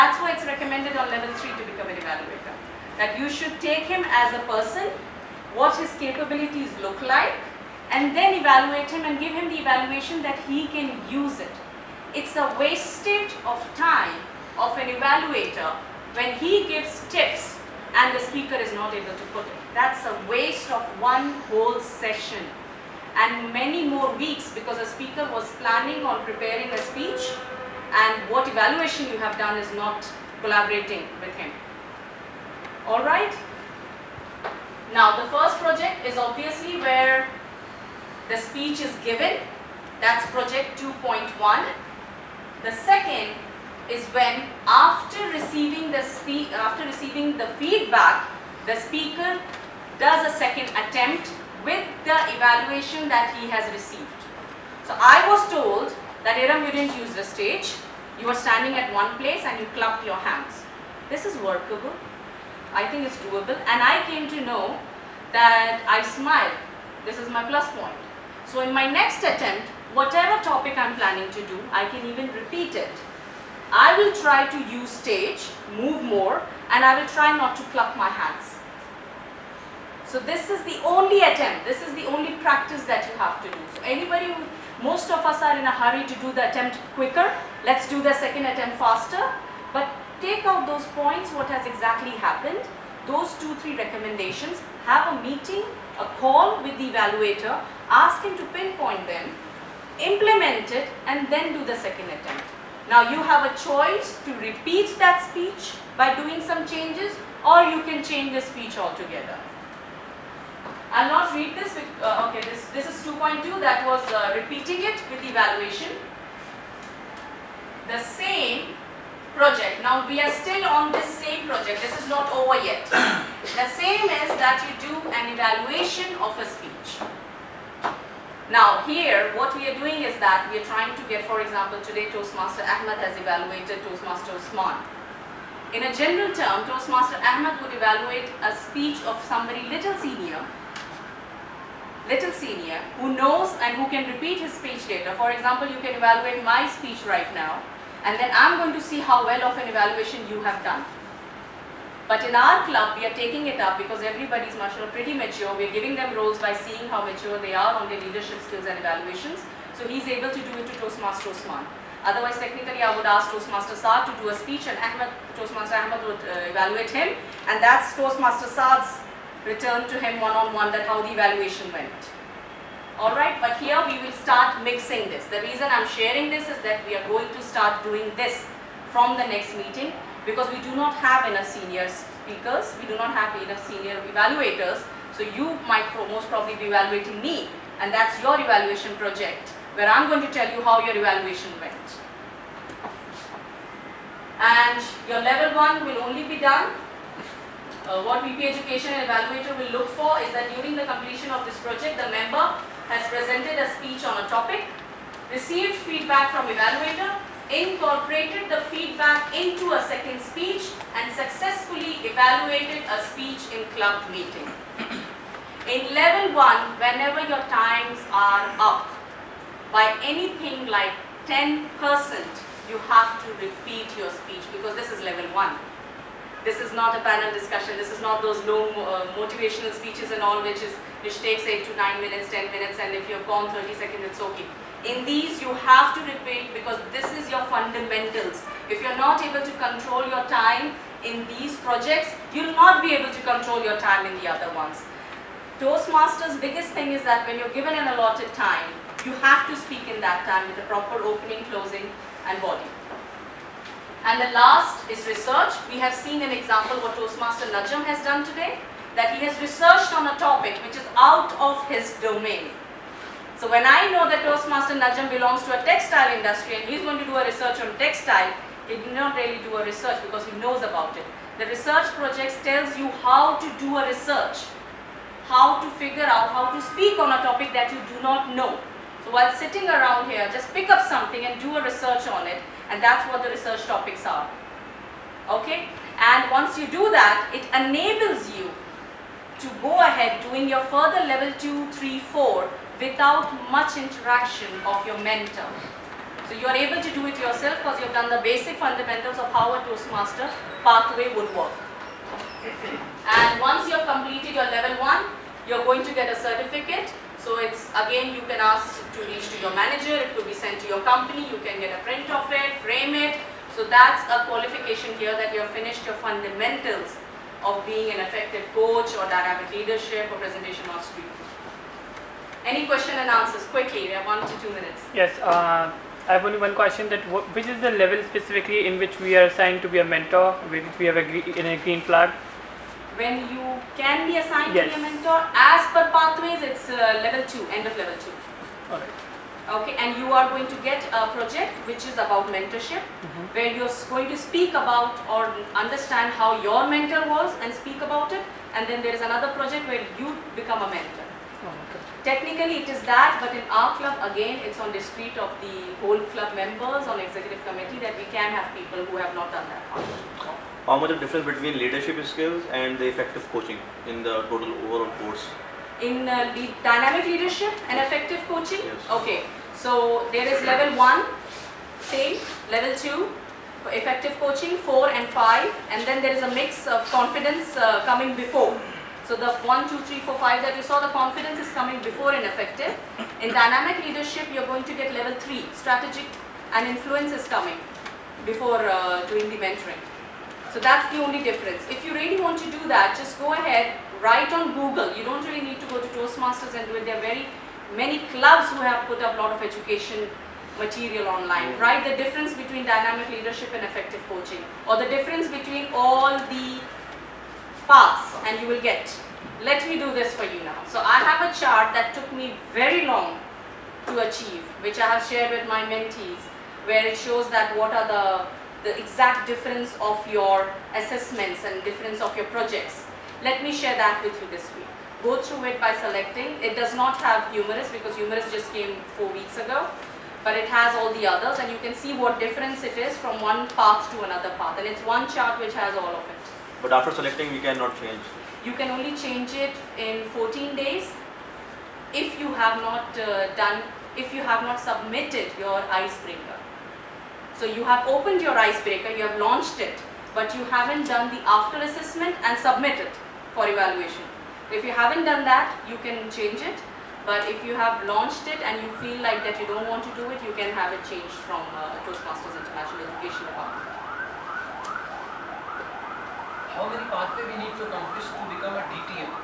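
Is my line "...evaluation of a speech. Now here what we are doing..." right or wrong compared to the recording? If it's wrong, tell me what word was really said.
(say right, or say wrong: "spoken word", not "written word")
right.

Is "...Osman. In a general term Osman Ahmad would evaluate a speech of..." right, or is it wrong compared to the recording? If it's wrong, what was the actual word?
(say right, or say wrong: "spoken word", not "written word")
wrong: "Toastmaster", not "Osman".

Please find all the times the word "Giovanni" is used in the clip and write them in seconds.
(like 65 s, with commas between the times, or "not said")
not said.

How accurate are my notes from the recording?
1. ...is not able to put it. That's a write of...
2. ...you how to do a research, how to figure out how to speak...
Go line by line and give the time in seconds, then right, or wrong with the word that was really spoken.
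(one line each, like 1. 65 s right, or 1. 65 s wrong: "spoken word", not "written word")
1. 18 s wrong: "waste", not "write"
2. 272 s right.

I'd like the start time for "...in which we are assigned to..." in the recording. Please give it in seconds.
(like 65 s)
328 s.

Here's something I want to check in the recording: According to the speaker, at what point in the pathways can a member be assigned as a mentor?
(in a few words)
end of level 2.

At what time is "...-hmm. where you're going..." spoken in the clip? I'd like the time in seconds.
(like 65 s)
343 s.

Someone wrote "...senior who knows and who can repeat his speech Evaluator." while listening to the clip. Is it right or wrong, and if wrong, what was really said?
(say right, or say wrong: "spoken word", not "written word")
wrong: "Data", not "Evaluator".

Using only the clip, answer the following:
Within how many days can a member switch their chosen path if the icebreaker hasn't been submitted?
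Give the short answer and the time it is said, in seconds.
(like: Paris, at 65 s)
14, at 440 s.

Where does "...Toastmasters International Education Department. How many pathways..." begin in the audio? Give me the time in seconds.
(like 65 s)
461 s.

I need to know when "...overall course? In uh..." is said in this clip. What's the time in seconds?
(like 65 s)
364 s.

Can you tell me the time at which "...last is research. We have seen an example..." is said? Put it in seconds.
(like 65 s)
254 s.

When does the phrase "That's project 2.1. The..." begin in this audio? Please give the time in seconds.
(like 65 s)
40 s.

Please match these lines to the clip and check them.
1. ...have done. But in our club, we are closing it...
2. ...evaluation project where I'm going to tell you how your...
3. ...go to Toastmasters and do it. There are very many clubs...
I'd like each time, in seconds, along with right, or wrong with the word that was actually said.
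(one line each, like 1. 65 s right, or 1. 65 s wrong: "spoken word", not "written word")
1. 150 s wrong: "taking", not "closing"
2. 188 s right
3. 395 s right.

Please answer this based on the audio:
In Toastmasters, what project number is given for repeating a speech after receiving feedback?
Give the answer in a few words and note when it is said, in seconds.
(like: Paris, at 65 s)
2.2, at 112 s.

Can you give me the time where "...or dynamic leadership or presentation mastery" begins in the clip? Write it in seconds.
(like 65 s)
318 s.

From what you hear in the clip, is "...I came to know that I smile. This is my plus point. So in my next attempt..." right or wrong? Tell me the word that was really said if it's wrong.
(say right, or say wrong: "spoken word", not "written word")
right.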